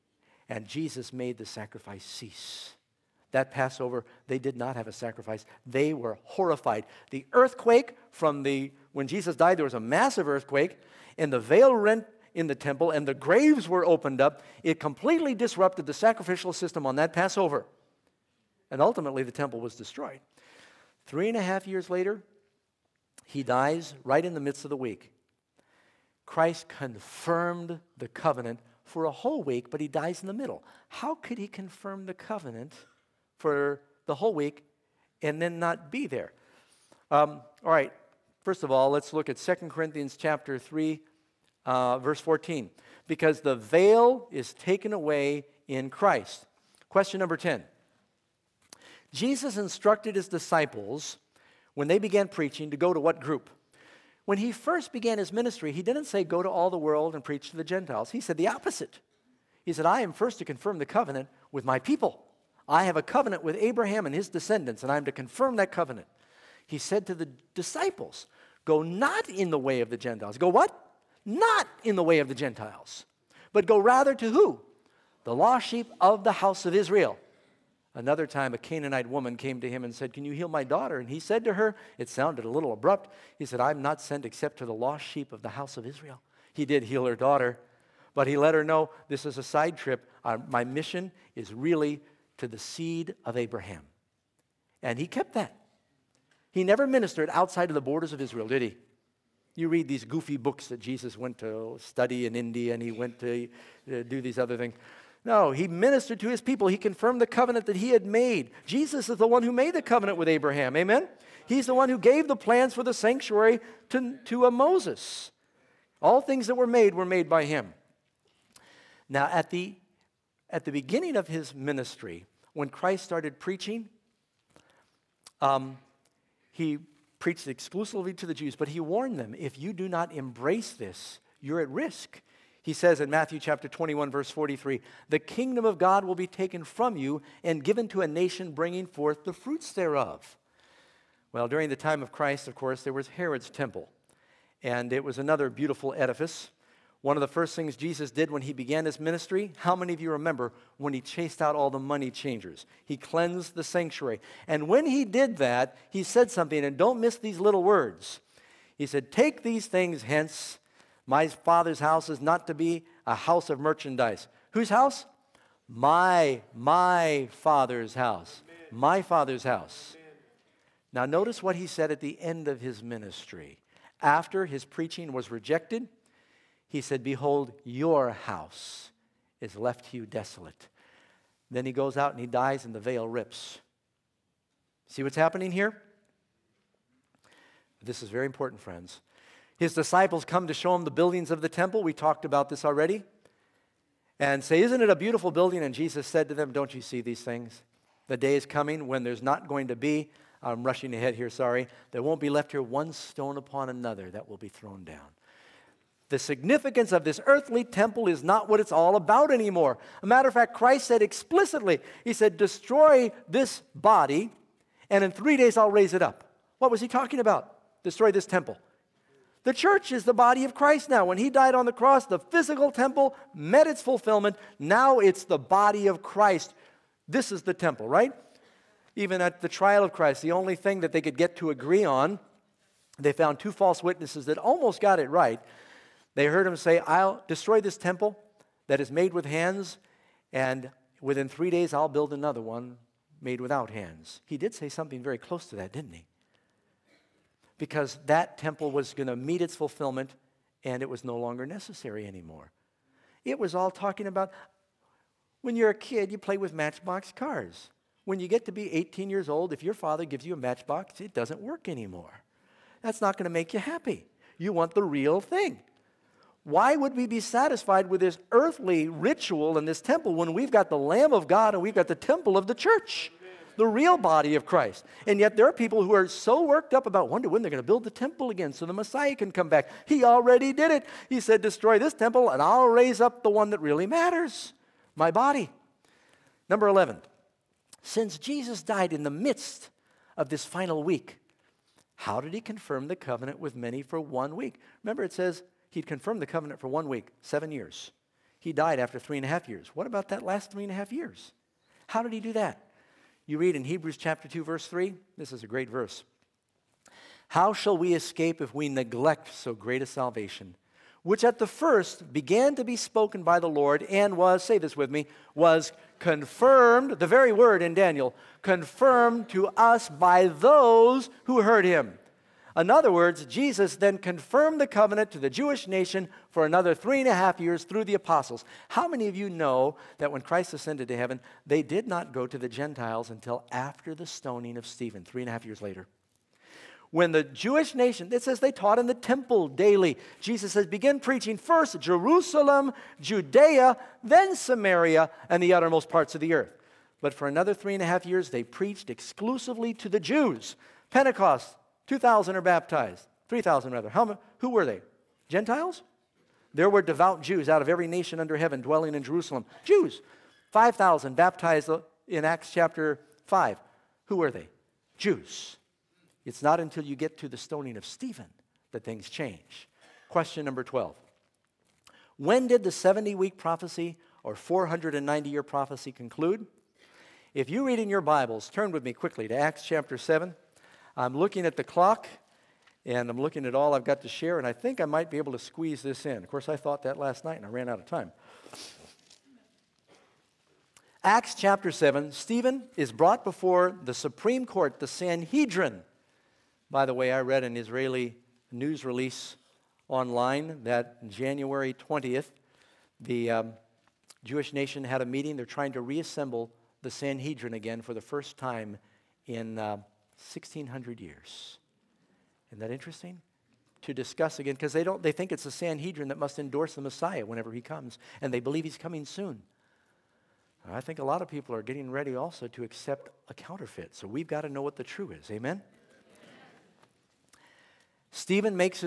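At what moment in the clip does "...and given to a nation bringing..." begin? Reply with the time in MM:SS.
02:17.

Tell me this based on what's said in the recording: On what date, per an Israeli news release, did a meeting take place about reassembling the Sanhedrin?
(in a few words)
January 20th.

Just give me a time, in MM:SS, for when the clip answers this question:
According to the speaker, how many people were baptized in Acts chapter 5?
06:00.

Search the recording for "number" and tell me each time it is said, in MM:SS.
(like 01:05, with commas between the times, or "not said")
00:47, 04:46, 06:10.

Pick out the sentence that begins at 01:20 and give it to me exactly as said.
And he said to her, It sounded a little abrupt.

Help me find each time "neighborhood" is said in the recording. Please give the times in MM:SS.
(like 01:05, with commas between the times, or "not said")
not said.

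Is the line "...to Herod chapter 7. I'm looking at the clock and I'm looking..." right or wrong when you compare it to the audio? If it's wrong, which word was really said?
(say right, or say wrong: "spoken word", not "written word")
wrong: "Acts", not "Herod".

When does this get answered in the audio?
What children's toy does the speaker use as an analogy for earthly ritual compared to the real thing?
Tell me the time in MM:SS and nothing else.
04:16.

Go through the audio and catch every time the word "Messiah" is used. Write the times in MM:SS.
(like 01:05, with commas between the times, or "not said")
04:38, 06:56.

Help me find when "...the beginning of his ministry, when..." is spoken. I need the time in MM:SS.
02:00.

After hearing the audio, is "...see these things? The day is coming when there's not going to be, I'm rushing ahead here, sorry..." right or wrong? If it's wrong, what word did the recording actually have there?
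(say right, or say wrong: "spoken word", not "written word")
right.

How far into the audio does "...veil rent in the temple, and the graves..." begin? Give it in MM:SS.
00:11.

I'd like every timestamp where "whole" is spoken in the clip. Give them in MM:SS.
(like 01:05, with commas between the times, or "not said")
00:29, 00:34.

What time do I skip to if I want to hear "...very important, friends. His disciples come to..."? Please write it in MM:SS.
03:08.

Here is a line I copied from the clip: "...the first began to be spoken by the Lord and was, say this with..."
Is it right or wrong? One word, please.
right.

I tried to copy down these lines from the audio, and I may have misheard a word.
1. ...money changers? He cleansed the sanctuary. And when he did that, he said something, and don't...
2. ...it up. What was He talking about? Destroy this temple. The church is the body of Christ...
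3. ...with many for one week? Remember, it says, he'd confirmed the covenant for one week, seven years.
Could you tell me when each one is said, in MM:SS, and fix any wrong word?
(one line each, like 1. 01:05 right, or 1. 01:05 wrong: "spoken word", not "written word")
1. 02:31 right
2. 03:35 right
3. 04:53 right.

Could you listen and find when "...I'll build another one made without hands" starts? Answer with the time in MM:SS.
04:01.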